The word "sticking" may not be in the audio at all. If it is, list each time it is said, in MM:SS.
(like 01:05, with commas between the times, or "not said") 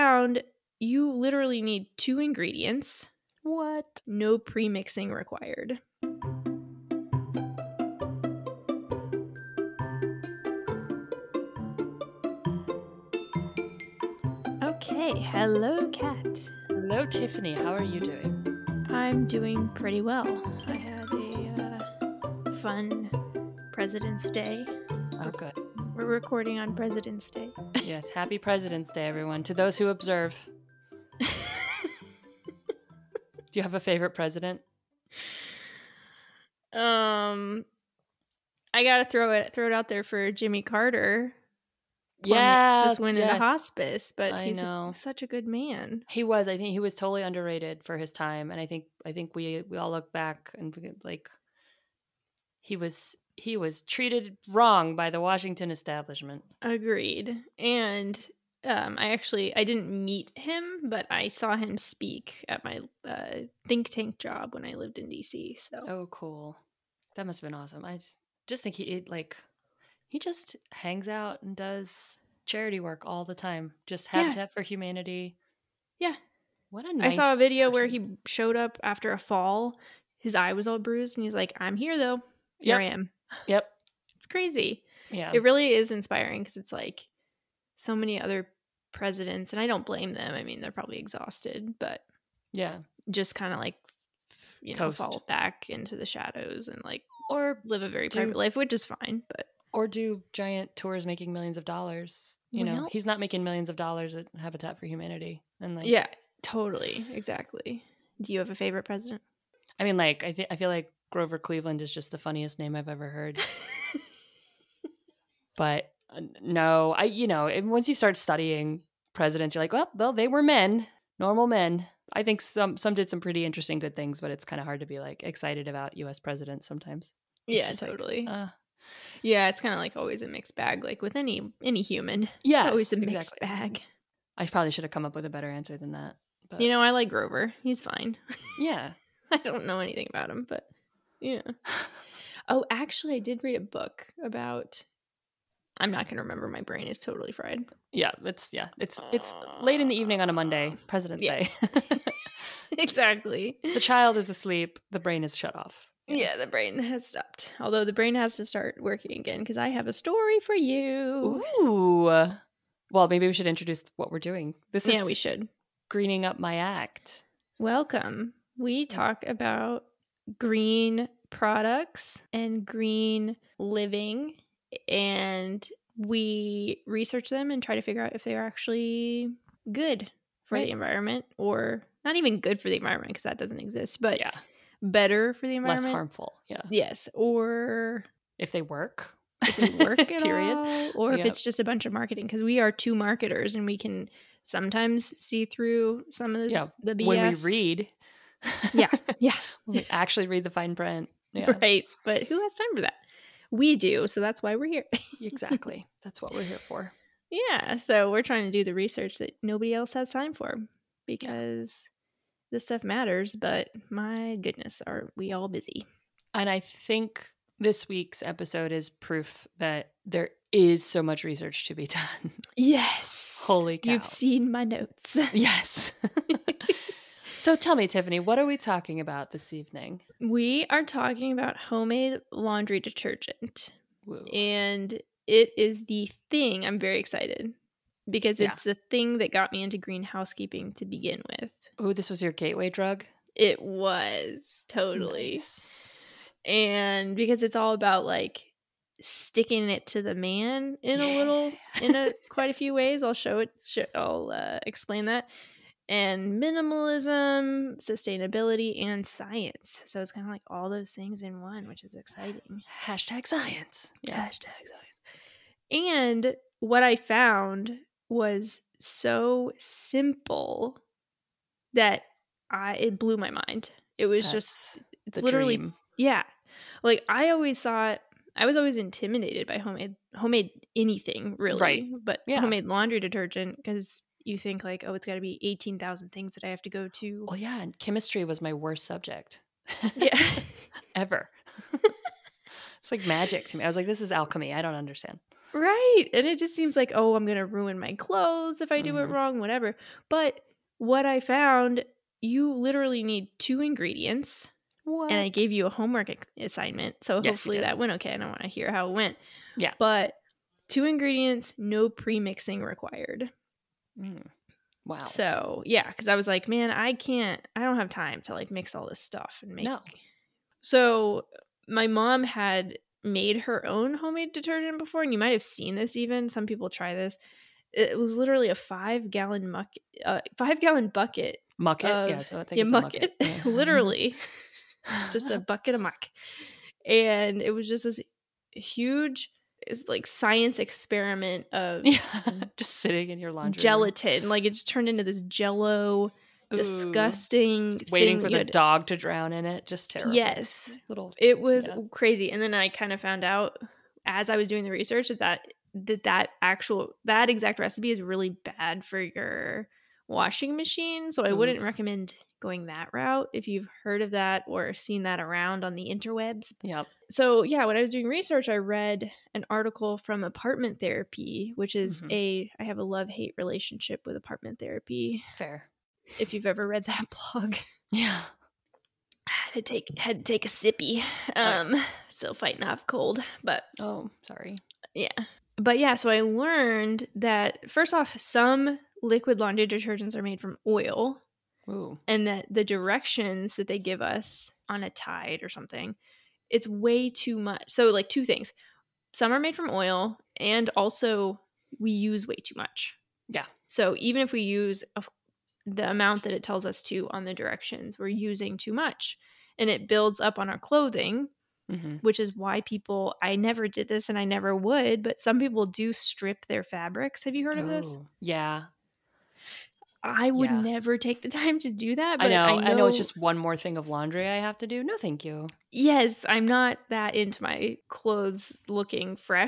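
04:09.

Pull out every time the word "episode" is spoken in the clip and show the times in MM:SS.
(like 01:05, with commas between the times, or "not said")
03:38.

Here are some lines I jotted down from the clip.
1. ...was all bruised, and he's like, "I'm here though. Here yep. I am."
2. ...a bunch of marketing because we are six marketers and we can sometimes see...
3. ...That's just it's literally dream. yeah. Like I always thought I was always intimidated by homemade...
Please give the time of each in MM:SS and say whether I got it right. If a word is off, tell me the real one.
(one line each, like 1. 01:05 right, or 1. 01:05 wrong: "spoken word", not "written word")
1. 01:20 right
2. 03:11 wrong: "two", not "six"
3. 04:34 right.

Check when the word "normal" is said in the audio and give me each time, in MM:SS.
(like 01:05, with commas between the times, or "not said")
02:01.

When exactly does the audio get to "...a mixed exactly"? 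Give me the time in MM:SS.
02:12.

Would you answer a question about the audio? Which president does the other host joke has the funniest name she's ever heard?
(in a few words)
Grover Cleveland.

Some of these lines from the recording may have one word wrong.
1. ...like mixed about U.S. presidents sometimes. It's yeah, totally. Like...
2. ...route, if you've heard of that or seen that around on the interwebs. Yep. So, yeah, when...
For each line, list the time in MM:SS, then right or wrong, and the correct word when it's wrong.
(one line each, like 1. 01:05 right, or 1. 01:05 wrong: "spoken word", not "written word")
1. 02:04 wrong: "excited", not "mixed"
2. 06:02 right.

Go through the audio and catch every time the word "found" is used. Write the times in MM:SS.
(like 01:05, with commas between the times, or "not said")
04:26, 05:01, 05:52.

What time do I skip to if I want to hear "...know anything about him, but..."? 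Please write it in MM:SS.
02:19.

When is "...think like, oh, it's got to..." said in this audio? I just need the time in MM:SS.
04:44.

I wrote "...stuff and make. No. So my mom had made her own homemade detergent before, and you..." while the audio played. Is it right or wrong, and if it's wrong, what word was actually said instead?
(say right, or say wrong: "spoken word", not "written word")
right.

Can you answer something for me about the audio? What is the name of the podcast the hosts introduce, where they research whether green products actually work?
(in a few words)
Greening Up My Act.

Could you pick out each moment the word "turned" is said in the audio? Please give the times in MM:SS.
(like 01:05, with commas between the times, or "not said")
05:44.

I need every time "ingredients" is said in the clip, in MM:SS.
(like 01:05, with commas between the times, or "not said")
00:02, 05:03, 05:10.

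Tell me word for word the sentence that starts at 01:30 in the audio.
I mean, they're probably exhausted, but yeah, just kind of like you Coast.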